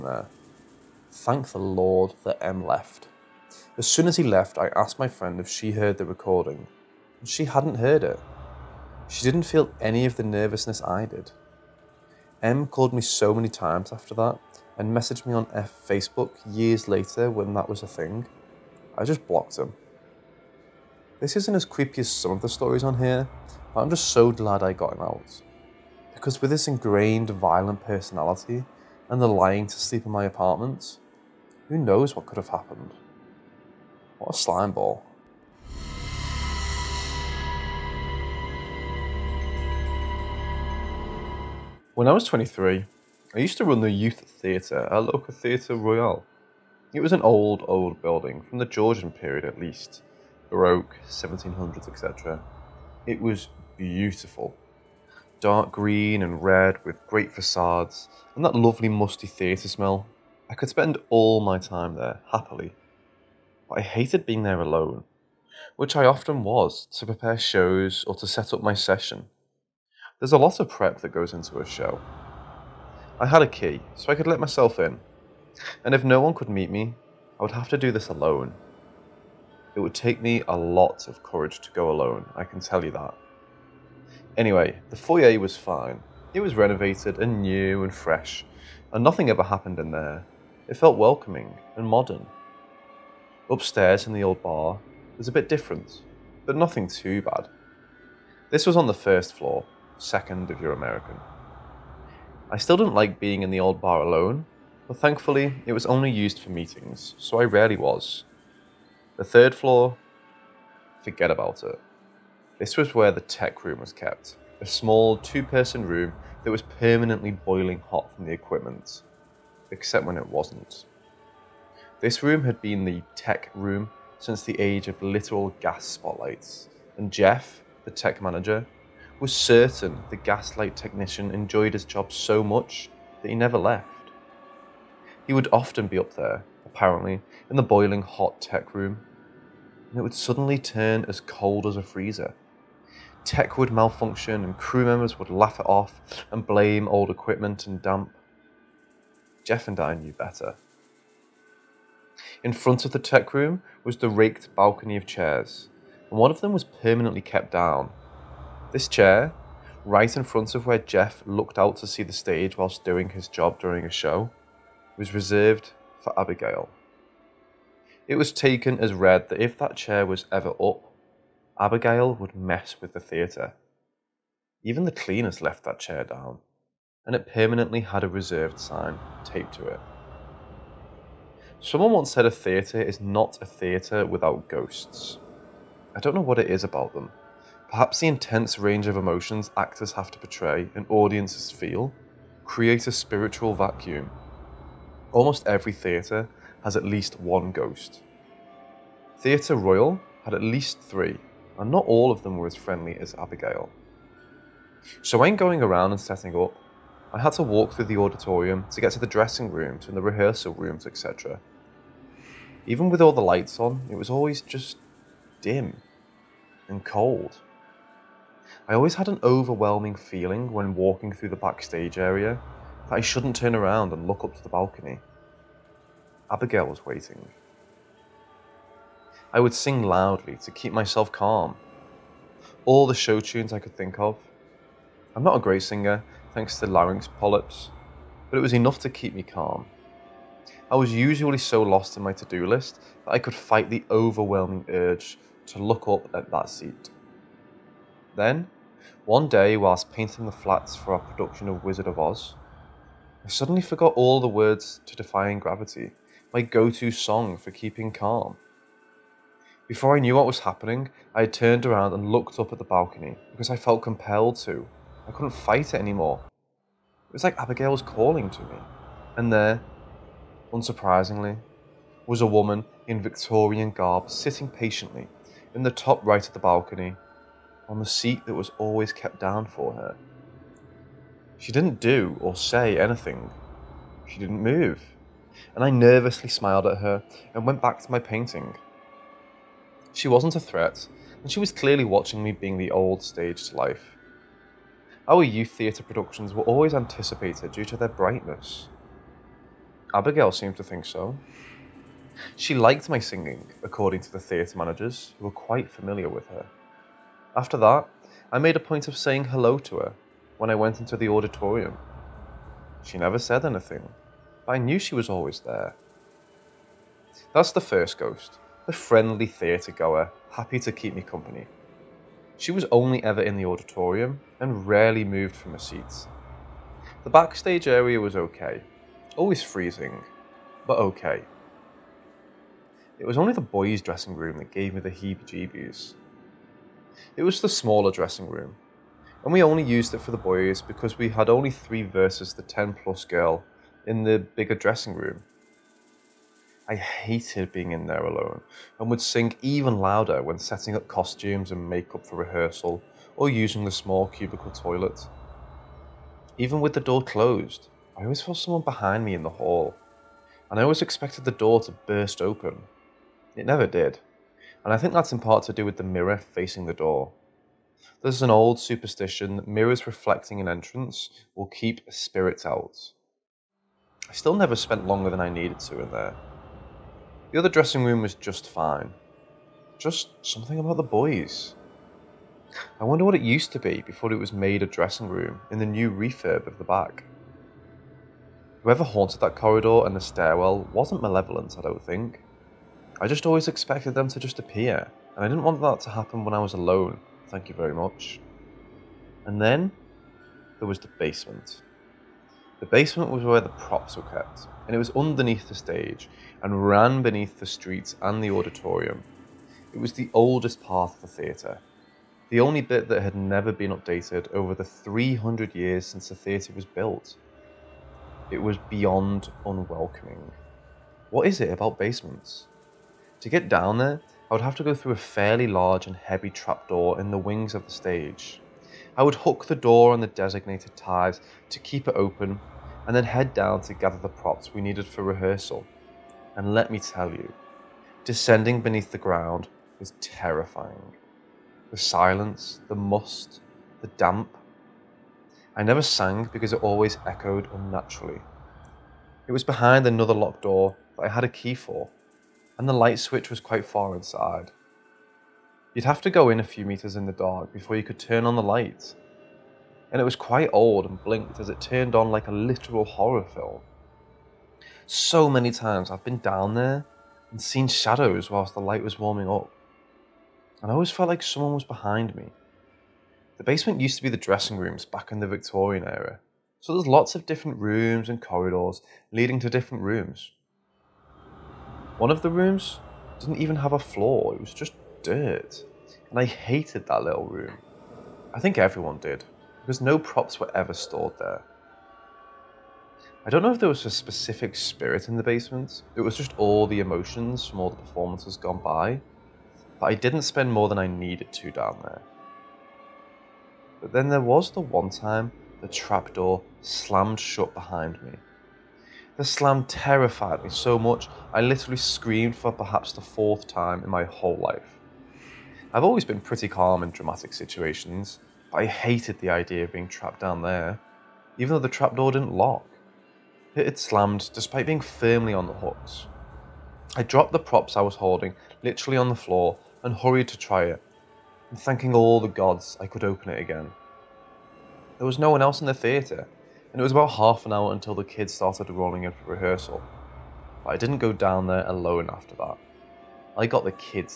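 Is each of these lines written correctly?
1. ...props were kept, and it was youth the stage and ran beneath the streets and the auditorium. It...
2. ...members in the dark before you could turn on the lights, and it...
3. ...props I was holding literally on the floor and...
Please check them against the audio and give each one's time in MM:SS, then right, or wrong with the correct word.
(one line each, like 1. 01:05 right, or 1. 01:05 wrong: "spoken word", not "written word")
1. 06:43 wrong: "underneath", not "youth"
2. 07:36 wrong: "meters", not "members"
3. 08:47 right.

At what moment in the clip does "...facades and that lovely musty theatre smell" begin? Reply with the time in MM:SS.
00:57.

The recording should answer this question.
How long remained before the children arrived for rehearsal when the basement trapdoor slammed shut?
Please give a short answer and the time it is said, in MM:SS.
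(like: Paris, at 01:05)
Half an hour, at 08:57.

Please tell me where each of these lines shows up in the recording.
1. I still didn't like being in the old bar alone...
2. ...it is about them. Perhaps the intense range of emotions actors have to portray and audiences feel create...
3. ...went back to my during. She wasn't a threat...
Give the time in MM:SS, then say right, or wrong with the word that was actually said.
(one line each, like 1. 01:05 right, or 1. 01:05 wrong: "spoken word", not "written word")
1. 01:42 right
2. 03:06 right
3. 04:47 wrong: "painting", not "during".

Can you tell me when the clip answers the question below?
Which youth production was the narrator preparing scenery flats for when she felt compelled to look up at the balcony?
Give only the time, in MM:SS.
04:11.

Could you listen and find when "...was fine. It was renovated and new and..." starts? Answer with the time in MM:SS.
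01:25.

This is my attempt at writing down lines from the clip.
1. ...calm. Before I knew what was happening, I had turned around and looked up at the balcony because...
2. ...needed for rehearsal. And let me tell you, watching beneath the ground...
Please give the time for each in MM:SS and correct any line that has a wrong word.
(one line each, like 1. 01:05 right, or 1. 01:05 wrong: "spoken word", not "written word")
1. 04:17 right
2. 07:14 wrong: "descending", not "watching".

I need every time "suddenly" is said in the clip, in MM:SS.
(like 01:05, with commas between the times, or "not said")
02:20, 04:13.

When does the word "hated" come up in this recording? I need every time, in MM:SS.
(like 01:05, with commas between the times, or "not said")
01:03, 05:46, 08:06, 08:38.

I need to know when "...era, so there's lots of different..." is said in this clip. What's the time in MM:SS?
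07:55.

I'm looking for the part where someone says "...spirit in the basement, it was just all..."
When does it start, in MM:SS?
08:14.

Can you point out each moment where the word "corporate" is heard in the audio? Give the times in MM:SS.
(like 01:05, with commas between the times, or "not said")
not said.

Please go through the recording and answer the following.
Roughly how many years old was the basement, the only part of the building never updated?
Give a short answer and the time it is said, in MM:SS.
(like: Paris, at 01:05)
300, at 06:54.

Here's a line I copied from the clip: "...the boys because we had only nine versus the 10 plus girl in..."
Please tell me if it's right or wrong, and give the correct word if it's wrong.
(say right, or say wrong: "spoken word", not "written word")
wrong: "three", not "nine".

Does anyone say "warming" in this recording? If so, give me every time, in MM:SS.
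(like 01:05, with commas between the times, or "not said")
07:48.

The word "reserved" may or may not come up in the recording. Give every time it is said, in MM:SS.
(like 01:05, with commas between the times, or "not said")
02:45, 02:58.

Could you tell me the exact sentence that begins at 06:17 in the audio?
The other dressing room was just fine.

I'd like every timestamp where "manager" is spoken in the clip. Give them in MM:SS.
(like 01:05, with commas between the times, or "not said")
02:08, 05:04.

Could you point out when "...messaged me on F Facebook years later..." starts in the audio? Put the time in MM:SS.
00:14.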